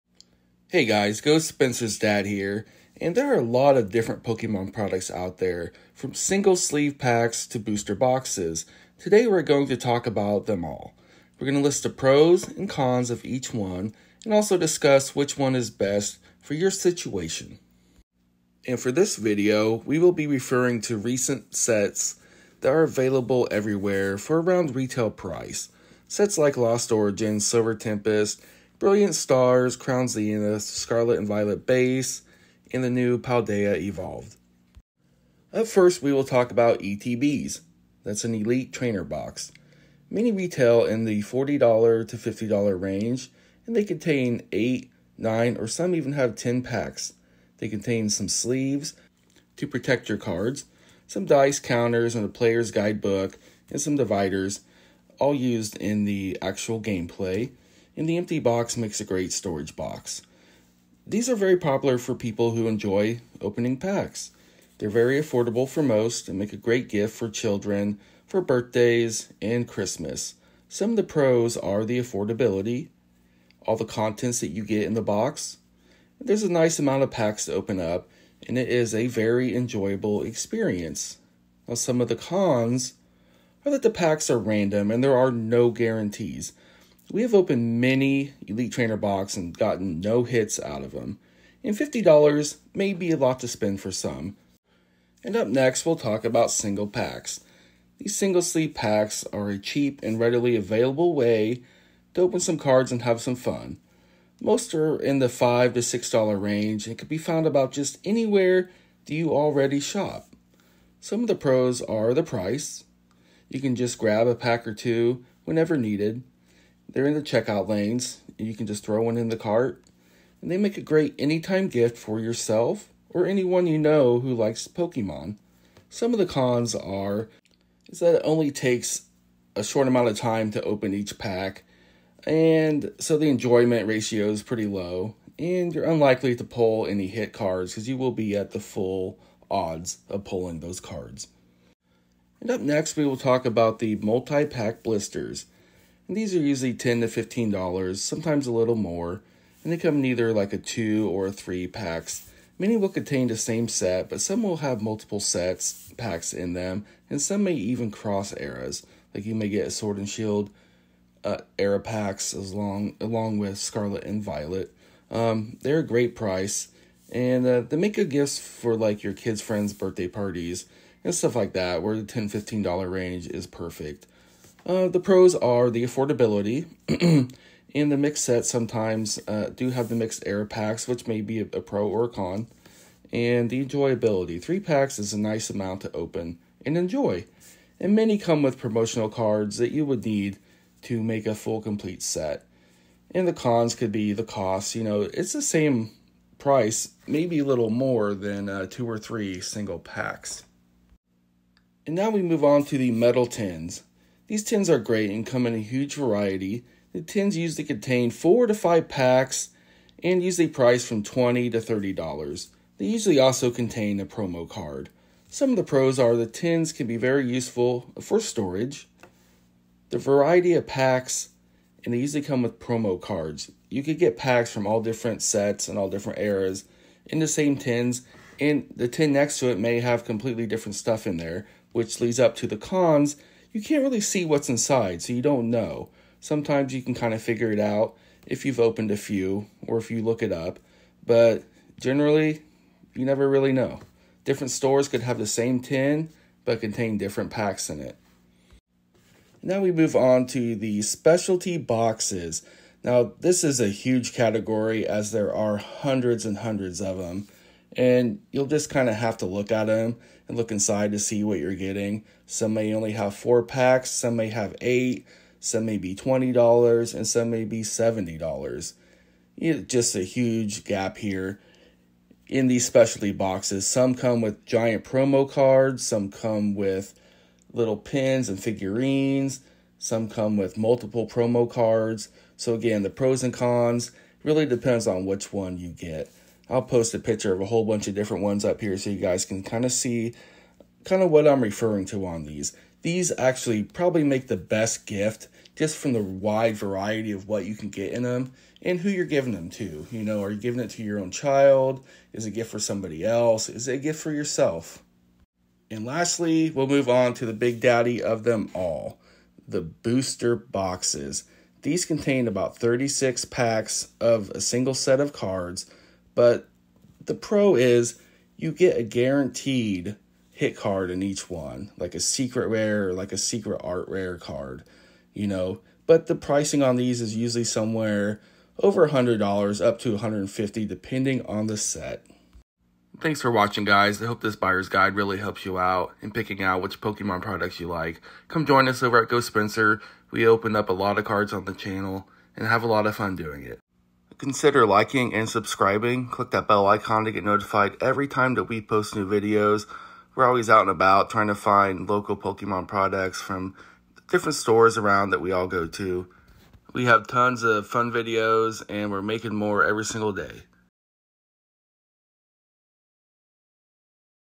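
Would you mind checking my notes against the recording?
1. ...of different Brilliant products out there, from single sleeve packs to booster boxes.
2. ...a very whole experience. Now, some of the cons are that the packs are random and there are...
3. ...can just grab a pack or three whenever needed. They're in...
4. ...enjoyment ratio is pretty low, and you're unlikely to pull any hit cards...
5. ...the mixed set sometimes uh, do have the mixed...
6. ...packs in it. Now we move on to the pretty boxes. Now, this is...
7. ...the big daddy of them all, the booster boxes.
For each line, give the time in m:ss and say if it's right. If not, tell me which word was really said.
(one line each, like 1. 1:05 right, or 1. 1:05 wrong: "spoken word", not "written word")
1. 0:03 wrong: "Pokemon", not "Brilliant"
2. 1:18 wrong: "enjoyable", not "whole"
3. 1:53 wrong: "two", not "three"
4. 2:13 right
5. 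2:57 right
6. 4:07 wrong: "specialty", not "pretty"
7. 5:07 right.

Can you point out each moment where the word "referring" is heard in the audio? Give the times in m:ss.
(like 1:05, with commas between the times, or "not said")
0:20, 4:51.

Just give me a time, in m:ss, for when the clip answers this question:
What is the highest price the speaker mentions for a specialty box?
4:27.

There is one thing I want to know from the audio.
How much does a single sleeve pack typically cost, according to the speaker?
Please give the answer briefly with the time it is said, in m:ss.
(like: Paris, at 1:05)
$5 to $6, at 1:45.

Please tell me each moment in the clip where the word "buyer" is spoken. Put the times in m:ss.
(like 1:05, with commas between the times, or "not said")
5:34.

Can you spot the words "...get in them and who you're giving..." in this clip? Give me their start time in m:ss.
4:57.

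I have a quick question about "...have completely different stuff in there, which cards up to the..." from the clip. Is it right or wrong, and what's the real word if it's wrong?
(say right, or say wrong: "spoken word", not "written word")
wrong: "leads", not "cards".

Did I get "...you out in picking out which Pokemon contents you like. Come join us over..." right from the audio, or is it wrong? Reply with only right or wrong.
wrong.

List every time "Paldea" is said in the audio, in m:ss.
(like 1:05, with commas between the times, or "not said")
0:33.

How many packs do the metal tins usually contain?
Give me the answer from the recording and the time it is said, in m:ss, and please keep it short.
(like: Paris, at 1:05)
4 to 5, at 3:28.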